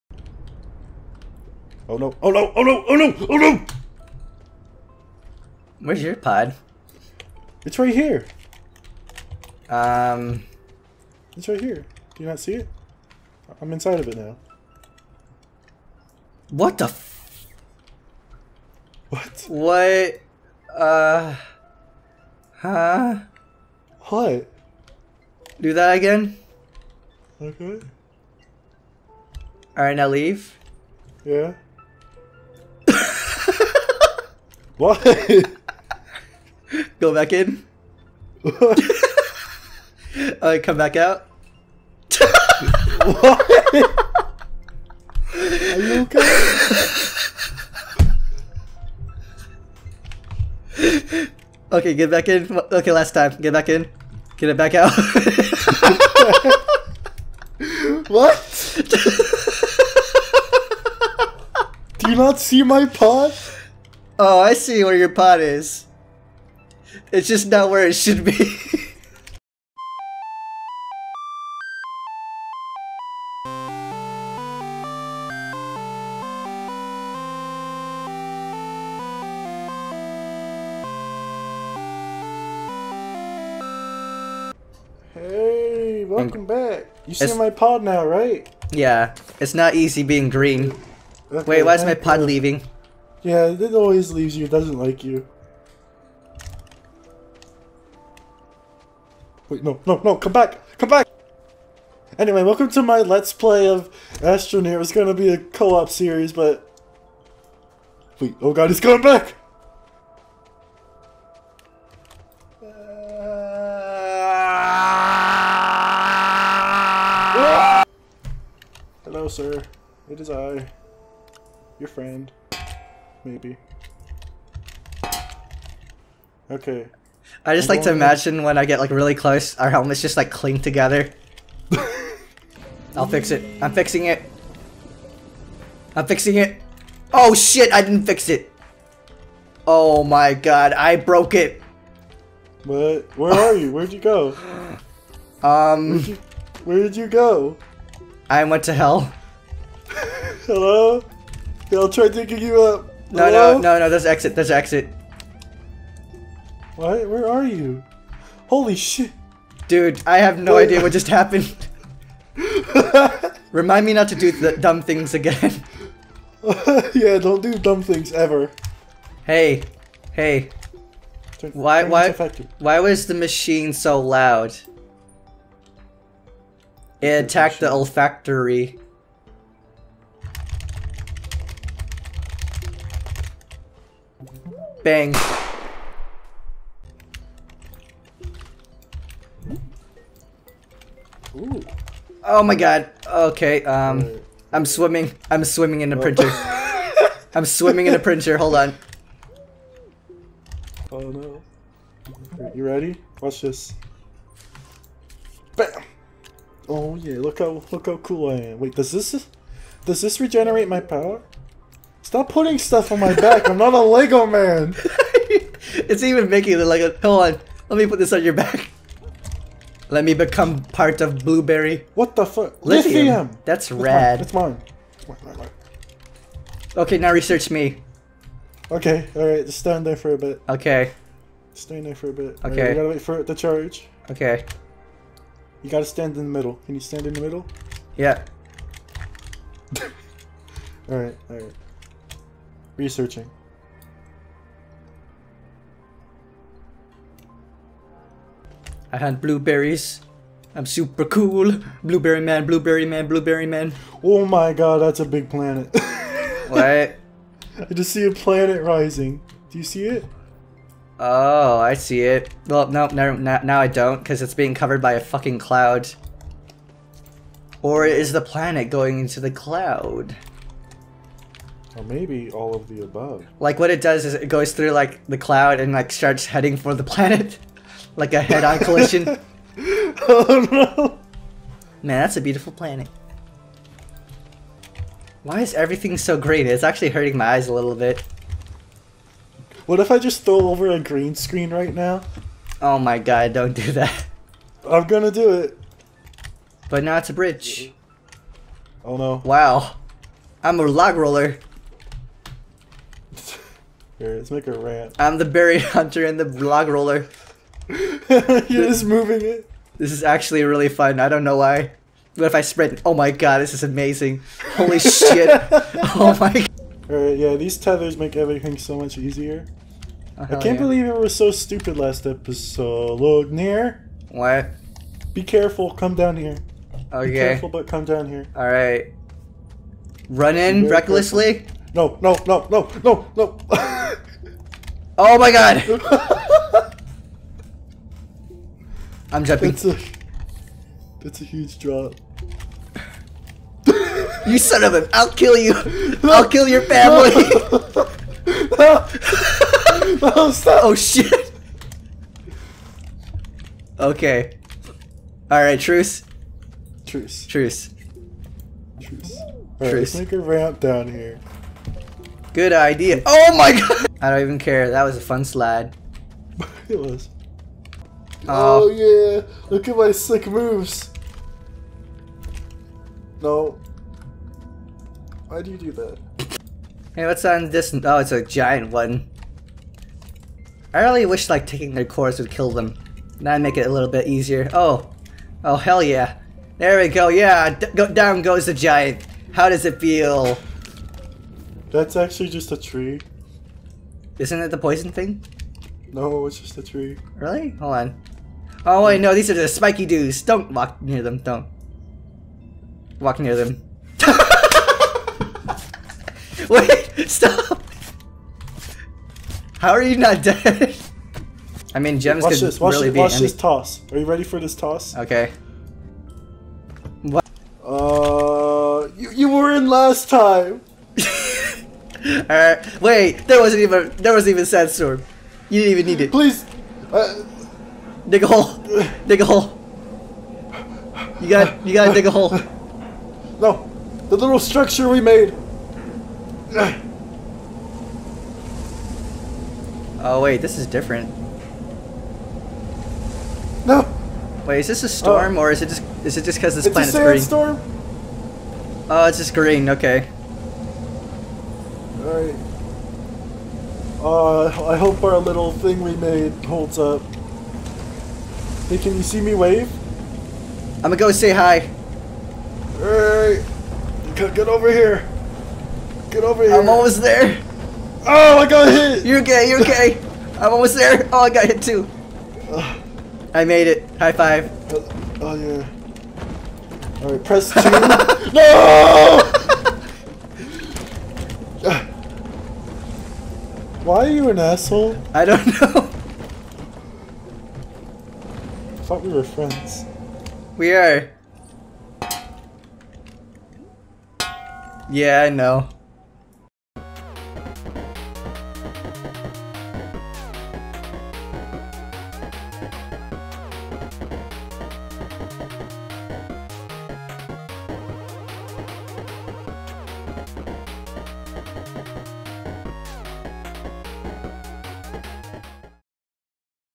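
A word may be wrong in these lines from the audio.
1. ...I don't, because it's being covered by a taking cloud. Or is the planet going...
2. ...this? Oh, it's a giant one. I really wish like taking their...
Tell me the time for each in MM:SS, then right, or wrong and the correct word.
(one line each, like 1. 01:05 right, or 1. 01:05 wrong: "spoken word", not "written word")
1. 04:23 wrong: "fucking", not "taking"
2. 06:17 right.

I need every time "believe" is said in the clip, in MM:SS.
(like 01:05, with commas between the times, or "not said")
05:20.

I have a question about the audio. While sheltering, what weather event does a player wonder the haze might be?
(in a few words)
sandstorm.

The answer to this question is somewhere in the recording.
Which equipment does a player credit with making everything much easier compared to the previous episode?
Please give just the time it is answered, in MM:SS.
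05:17.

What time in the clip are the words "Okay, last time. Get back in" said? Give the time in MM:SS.
00:52.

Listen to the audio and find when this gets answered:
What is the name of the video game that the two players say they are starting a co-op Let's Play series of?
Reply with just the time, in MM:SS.
01:44.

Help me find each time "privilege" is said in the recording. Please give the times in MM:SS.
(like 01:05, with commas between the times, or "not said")
not said.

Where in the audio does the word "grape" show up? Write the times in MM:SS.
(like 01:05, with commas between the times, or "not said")
not said.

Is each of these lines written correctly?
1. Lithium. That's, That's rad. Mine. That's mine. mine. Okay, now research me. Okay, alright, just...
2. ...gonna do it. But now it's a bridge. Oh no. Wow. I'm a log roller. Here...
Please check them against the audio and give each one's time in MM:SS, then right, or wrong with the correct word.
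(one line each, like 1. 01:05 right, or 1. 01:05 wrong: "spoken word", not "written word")
1. 03:42 right
2. 04:54 right.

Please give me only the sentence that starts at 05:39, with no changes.
That's a, that's a huge drop.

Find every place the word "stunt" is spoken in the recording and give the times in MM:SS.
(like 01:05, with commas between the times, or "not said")
not said.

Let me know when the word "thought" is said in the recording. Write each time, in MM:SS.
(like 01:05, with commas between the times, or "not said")
08:08.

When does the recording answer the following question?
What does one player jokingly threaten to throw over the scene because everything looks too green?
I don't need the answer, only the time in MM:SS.
04:50.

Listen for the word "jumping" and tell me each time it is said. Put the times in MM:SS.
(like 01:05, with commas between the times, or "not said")
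05:39.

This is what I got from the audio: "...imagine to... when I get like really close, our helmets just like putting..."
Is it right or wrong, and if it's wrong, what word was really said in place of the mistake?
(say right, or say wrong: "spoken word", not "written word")
wrong: "cling", not "putting".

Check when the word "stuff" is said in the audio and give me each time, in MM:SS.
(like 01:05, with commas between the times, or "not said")
03:32.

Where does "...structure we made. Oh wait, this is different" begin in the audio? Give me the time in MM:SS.
07:14.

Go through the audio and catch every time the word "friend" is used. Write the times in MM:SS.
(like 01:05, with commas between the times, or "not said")
02:01, 08:09.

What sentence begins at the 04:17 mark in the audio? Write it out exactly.
I just see a planet rising.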